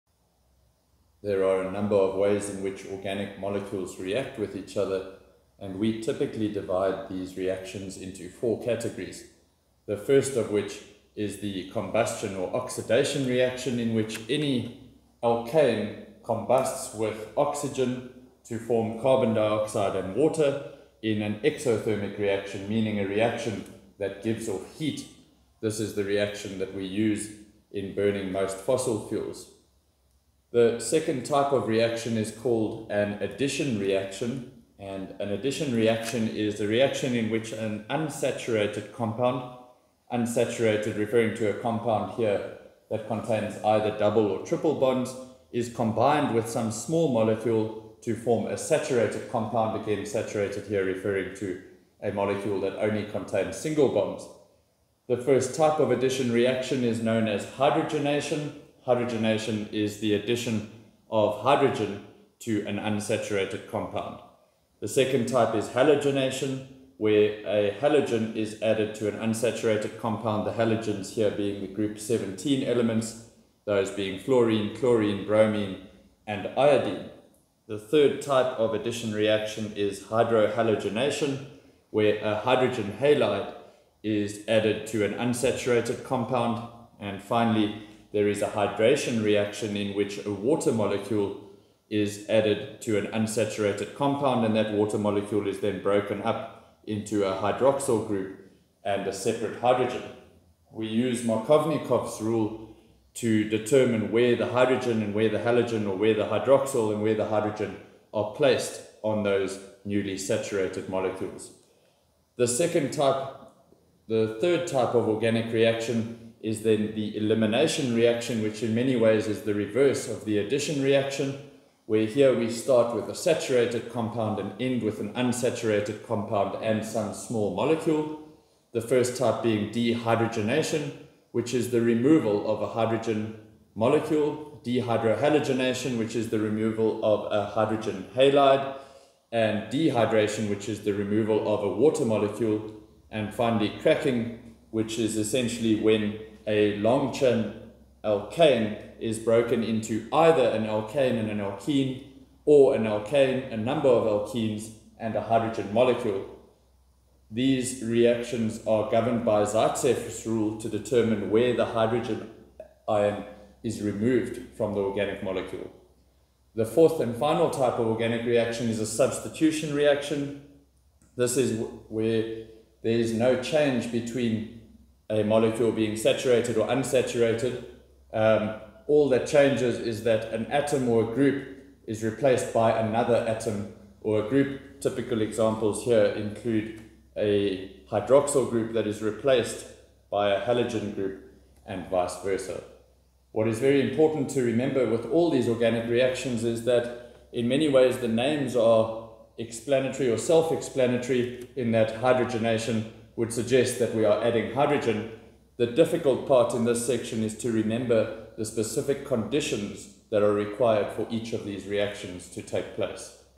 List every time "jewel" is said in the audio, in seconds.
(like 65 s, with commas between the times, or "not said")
not said.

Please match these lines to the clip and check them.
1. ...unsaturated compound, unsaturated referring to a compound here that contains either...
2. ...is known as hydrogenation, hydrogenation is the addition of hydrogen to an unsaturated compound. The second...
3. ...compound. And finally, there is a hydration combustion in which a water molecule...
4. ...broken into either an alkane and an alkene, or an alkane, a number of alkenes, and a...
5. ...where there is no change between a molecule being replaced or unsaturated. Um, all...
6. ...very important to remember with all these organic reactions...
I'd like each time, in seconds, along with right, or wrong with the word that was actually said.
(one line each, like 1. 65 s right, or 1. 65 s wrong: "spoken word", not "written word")
1. 37 s right
2. 56 s right
3. 86 s wrong: "reaction", not "combustion"
4. 149 s right
5. 171 s wrong: "saturated", not "replaced"
6. 193 s right.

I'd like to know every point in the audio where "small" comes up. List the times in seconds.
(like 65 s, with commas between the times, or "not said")
46 s, 127 s.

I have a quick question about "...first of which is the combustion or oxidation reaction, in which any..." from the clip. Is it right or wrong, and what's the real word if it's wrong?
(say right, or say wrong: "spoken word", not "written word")
right.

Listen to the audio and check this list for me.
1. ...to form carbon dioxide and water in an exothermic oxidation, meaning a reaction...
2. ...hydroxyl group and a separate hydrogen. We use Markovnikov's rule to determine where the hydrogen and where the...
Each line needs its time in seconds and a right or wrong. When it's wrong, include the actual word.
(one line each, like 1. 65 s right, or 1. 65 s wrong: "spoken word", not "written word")
1. 18 s wrong: "reaction", not "oxidation"
2. 97 s right.